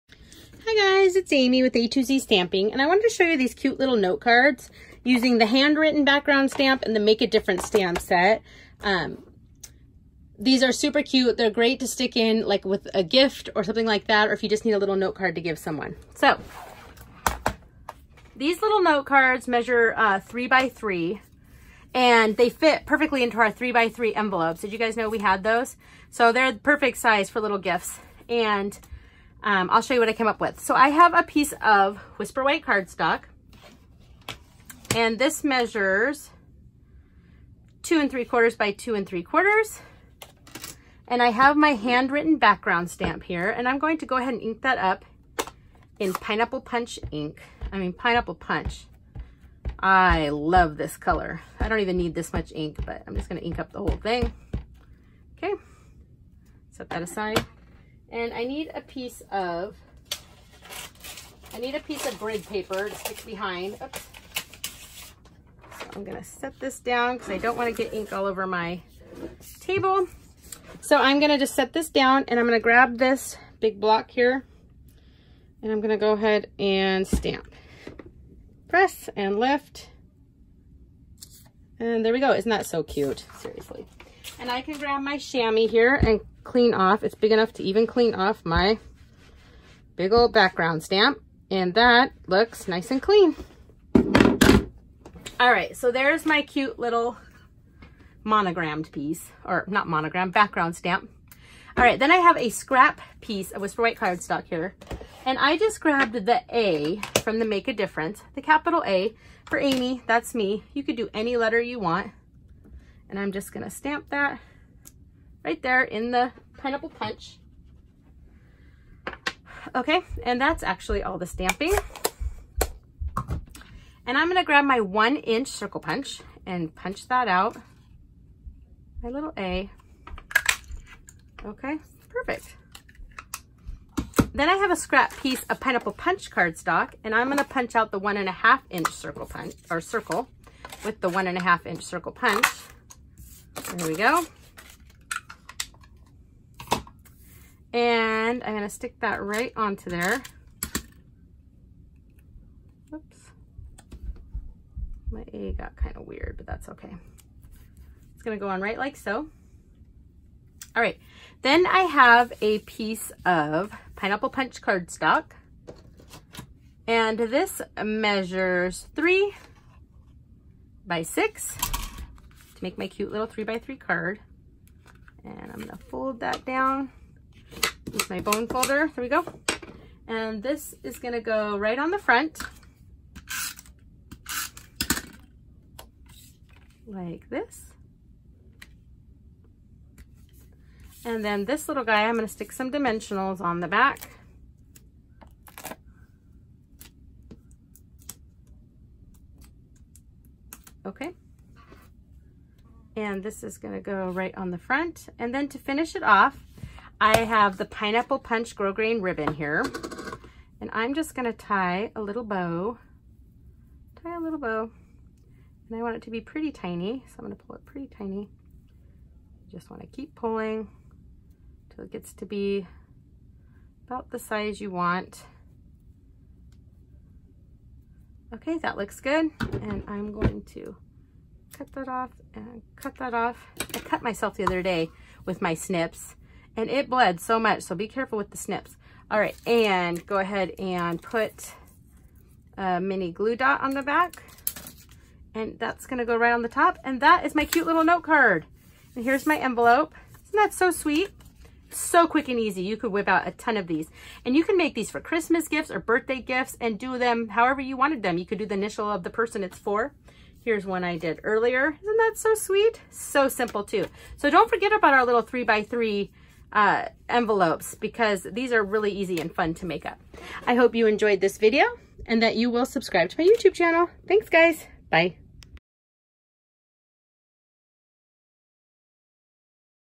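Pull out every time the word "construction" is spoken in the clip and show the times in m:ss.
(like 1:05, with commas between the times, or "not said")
not said.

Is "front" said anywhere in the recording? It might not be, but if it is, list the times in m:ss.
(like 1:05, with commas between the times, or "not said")
3:01, 3:24.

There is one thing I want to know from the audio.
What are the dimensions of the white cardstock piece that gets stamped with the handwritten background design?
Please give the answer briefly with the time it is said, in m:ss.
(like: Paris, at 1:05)
2 3/4 by 2 3/4, at 0:37.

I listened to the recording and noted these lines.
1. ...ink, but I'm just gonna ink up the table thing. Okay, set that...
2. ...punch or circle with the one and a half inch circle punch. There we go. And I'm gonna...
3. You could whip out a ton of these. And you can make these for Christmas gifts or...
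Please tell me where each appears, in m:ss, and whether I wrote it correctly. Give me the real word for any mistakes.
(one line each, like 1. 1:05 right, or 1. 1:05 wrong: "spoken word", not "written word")
1. 0:52 wrong: "whole", not "table"
2. 2:19 right
3. 4:12 right.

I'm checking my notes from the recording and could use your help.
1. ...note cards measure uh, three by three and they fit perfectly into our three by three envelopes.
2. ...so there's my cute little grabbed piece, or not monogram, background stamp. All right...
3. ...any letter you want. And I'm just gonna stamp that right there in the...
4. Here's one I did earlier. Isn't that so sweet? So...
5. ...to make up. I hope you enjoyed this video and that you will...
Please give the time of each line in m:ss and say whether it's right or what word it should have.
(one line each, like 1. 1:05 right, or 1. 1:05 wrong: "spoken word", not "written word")
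1. 0:18 right
2. 1:35 wrong: "monogrammed", not "grabbed"
3. 1:51 right
4. 4:20 right
5. 4:29 right.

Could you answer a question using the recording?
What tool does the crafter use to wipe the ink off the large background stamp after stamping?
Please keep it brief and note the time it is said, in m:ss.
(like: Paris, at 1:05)
chamois, at 1:25.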